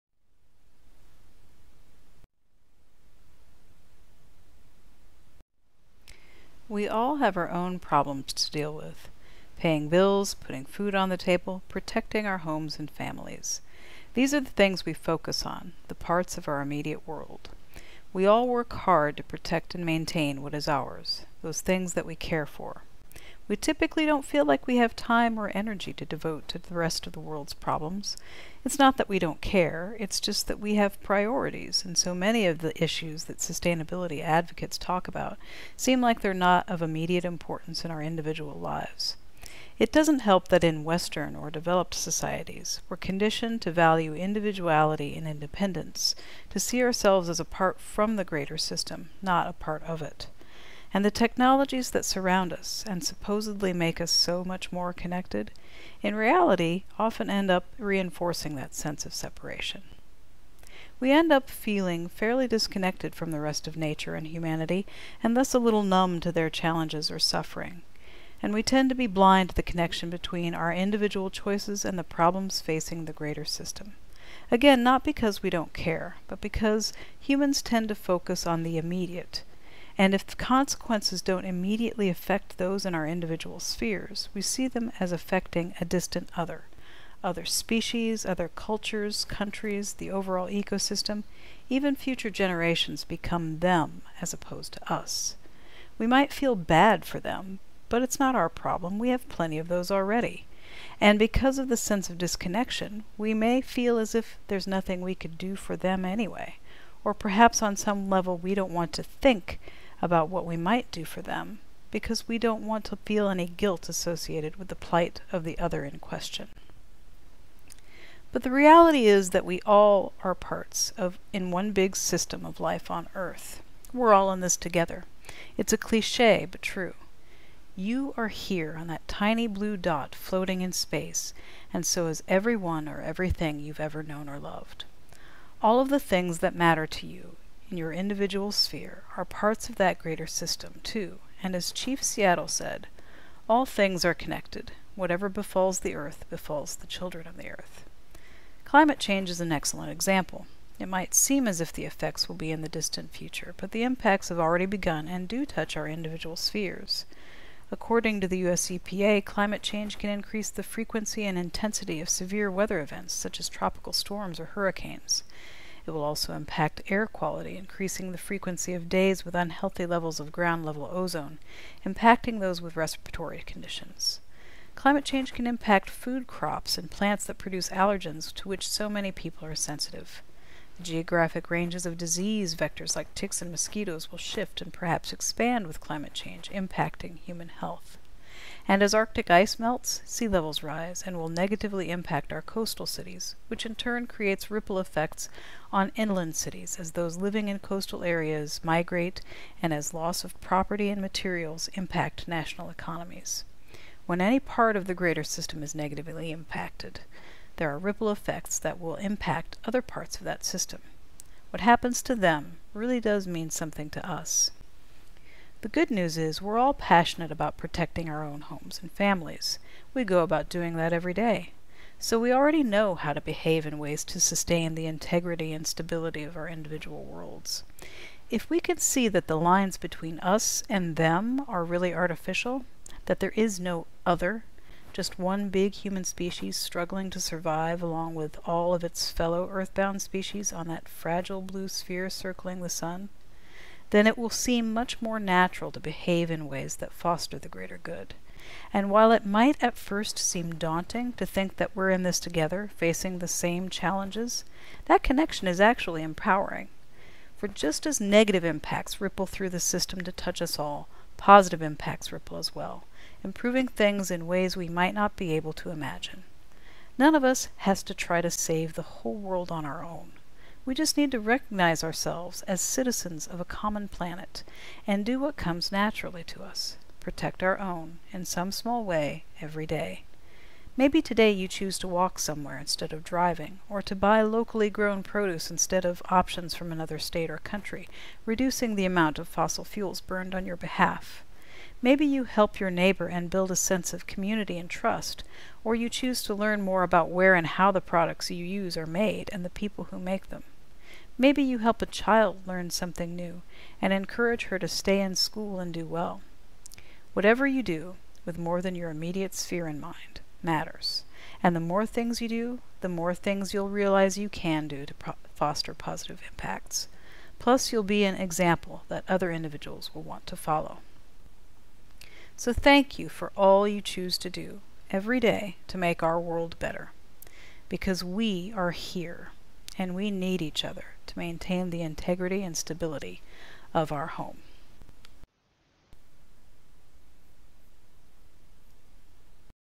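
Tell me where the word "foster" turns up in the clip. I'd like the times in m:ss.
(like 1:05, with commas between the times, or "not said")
4:06, 5:15.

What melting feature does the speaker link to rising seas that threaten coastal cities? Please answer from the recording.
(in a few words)
Arctic ice.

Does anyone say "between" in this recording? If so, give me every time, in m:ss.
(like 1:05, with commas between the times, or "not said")
1:10, 3:49.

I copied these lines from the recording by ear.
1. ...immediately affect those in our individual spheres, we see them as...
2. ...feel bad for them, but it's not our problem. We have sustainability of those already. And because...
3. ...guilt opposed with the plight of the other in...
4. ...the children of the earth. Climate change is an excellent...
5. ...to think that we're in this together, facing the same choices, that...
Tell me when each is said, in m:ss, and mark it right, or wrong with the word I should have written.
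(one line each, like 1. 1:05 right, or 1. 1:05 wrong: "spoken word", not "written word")
1. 1:21 right
2. 1:36 wrong: "plenty", not "sustainability"
3. 1:53 wrong: "associated", not "opposed"
4. 2:26 right
5. 4:11 wrong: "challenges", not "choices".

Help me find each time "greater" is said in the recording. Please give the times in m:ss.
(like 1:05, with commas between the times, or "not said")
0:48, 1:13, 2:19, 3:24, 4:07.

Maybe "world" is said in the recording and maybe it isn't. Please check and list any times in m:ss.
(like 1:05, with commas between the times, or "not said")
0:17, 0:27, 3:47, 4:29, 5:26.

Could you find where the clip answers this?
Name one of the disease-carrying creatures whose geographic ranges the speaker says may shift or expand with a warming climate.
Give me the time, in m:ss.
3:03.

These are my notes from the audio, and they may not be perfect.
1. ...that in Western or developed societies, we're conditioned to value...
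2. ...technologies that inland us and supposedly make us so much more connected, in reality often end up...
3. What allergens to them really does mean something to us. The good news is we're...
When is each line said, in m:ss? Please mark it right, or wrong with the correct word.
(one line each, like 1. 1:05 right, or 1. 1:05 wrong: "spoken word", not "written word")
1. 0:40 right
2. 0:51 wrong: "surround", not "inland"
3. 3:31 wrong: "happens", not "allergens".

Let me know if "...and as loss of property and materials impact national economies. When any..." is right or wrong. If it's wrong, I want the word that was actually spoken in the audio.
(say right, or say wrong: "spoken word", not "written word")
right.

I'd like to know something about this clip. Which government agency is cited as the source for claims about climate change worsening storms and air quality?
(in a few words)
US EPA.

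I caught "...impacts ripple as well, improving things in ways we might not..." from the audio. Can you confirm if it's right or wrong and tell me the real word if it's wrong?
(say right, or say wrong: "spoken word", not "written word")
right.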